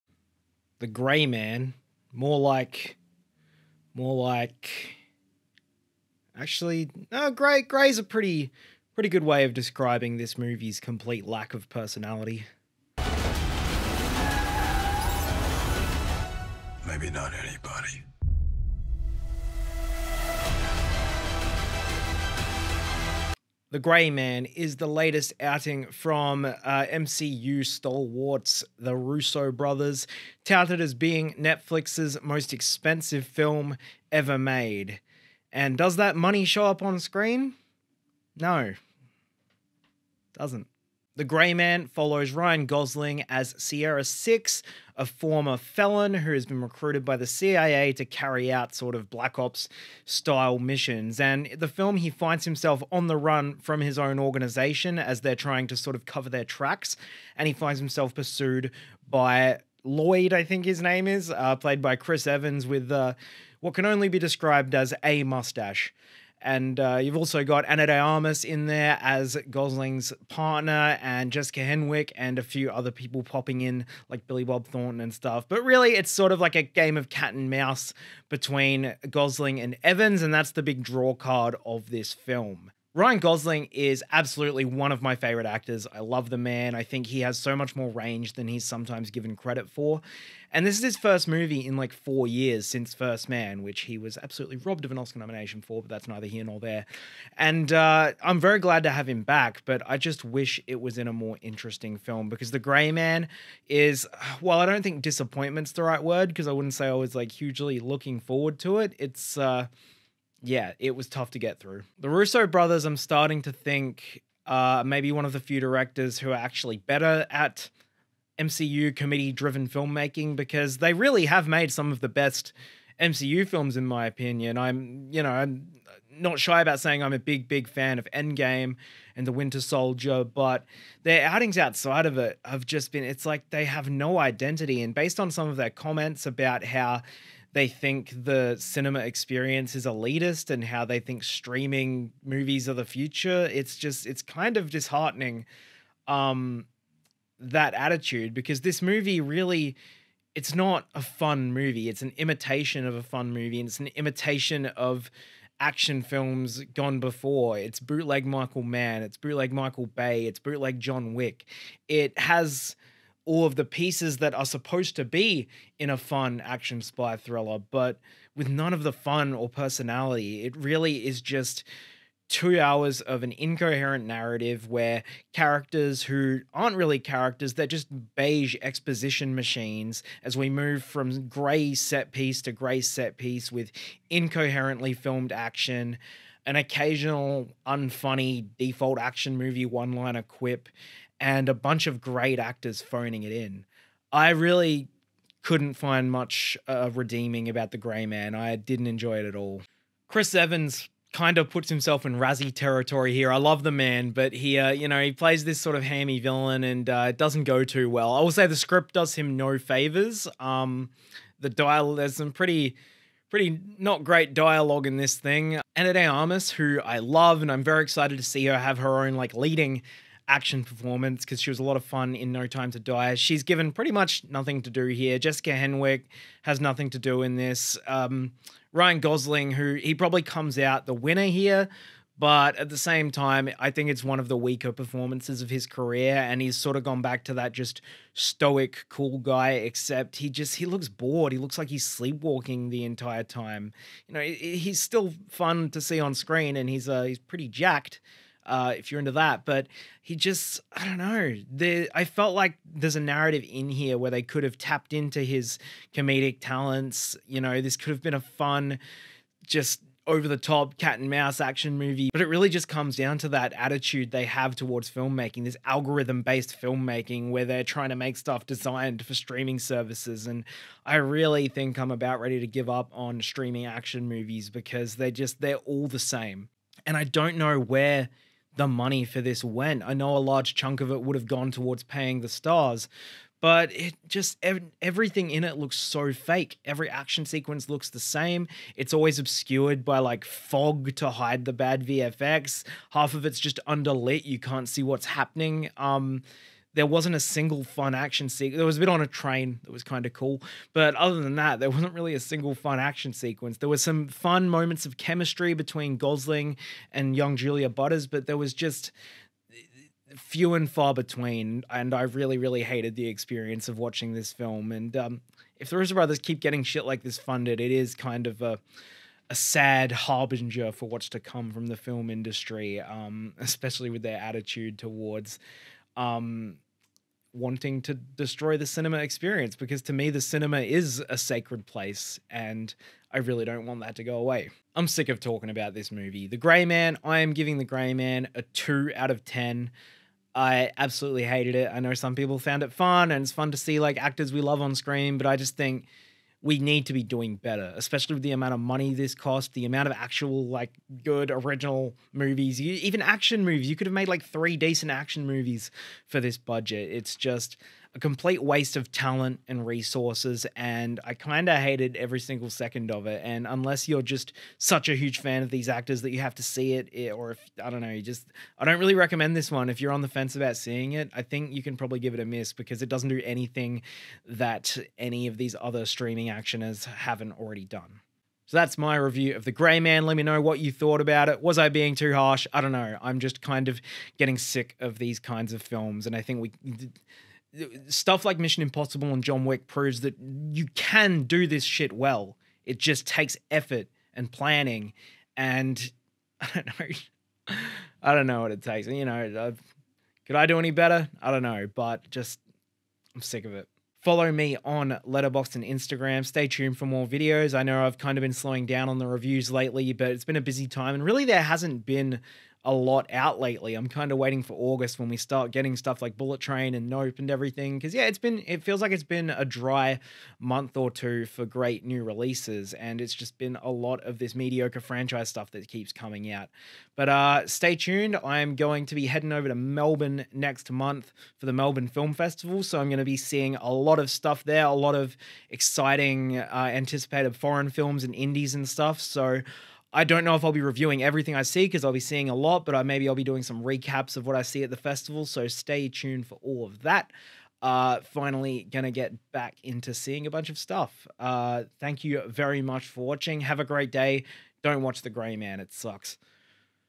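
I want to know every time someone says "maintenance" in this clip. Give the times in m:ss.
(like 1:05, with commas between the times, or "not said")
not said.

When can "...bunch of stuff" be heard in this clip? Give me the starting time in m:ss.
7:30.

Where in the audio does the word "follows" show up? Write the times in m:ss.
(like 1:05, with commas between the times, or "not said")
0:41, 6:44.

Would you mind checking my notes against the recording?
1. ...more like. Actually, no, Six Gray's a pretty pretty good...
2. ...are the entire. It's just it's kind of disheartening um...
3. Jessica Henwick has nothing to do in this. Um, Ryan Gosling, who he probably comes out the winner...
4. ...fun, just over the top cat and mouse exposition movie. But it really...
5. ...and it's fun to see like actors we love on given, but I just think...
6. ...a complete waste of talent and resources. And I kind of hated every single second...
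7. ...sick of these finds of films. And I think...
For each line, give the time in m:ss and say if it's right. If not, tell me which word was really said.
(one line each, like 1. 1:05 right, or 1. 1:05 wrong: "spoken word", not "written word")
1. 0:03 wrong: "Gray", not "Six"
2. 2:22 wrong: "future", not "entire"
3. 3:45 right
4. 4:18 wrong: "action", not "exposition"
5. 5:43 wrong: "screen", not "given"
6. 5:57 right
7. 6:24 wrong: "kinds", not "finds".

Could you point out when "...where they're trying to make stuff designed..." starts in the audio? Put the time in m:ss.
4:27.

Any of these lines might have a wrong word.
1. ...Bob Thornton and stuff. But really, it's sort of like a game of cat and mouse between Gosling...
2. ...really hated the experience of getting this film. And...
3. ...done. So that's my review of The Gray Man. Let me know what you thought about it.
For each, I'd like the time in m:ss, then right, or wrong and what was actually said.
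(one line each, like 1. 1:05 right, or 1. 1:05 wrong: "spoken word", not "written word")
1. 1:14 right
2. 5:12 wrong: "watching", not "getting"
3. 6:17 right.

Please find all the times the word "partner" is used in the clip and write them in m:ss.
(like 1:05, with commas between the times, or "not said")
1:10.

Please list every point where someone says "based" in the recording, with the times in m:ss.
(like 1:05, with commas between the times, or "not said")
2:14, 4:26.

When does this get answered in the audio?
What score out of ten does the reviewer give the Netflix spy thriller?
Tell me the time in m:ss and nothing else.
5:38.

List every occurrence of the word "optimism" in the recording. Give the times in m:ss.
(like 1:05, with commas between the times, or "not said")
not said.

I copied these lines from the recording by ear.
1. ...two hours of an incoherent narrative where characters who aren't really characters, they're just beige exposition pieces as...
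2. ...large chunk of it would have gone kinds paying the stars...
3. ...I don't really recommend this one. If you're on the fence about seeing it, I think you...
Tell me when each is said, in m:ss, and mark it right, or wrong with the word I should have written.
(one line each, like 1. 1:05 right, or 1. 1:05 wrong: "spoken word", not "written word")
1. 2:52 wrong: "machines", not "pieces"
2. 4:40 wrong: "towards", not "kinds"
3. 6:08 right.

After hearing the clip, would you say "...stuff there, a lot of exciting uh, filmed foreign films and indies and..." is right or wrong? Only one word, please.
wrong.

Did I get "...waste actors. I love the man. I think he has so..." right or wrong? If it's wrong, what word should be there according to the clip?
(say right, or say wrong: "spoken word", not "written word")
wrong: "favorite", not "waste".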